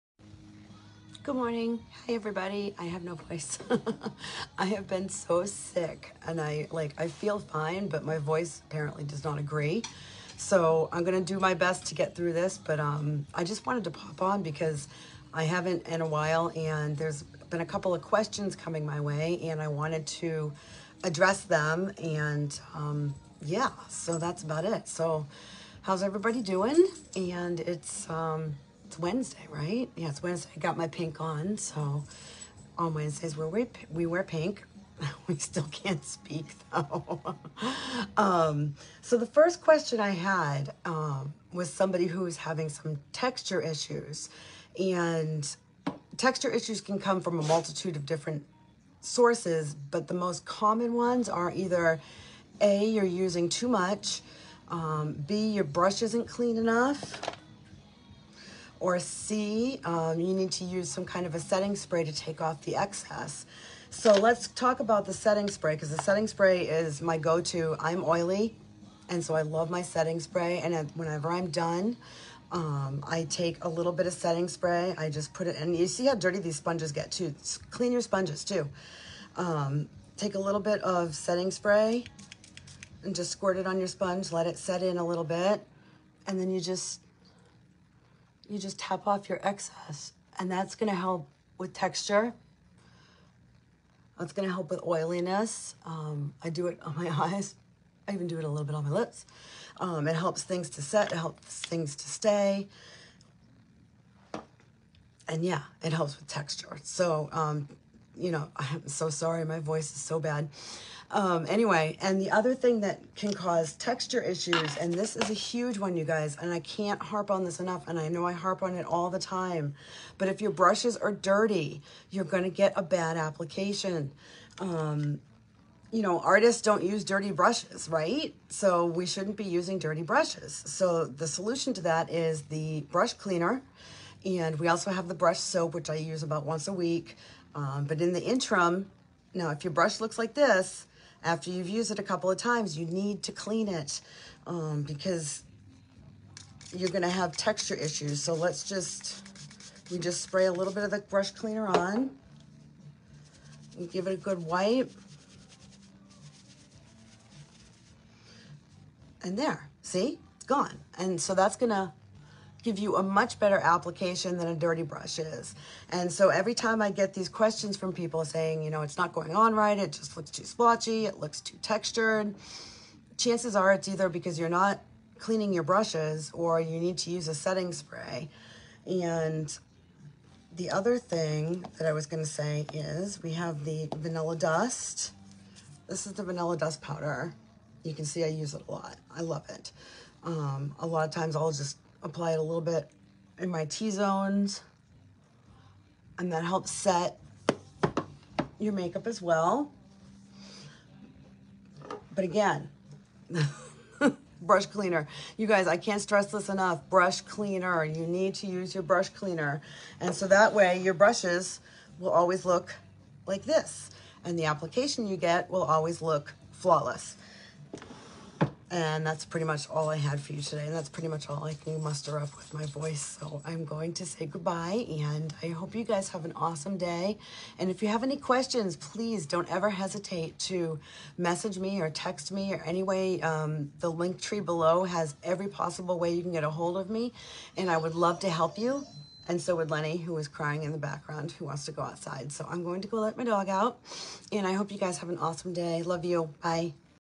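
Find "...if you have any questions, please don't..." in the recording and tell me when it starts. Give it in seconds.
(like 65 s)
227 s.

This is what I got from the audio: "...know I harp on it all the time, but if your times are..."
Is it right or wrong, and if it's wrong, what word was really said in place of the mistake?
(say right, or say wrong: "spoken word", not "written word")
wrong: "brushes", not "times".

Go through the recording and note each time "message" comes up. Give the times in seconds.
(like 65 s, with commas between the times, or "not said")
231 s.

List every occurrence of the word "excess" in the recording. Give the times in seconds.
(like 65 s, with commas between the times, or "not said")
62 s, 89 s.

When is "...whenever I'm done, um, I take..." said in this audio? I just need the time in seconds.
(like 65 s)
70 s.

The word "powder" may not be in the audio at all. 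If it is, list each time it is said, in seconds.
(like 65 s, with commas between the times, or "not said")
186 s.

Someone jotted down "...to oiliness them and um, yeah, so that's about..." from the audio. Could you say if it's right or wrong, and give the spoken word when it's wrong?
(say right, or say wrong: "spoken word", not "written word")
wrong: "address", not "oiliness".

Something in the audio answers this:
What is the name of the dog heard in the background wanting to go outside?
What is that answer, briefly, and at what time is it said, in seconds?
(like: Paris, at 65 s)
Lenny, at 239 s.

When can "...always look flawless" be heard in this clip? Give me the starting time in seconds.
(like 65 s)
215 s.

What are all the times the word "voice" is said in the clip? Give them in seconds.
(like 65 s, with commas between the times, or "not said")
3 s, 8 s, 109 s, 222 s.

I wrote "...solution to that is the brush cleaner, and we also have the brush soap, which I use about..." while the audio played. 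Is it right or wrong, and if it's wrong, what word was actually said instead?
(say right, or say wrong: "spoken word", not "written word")
right.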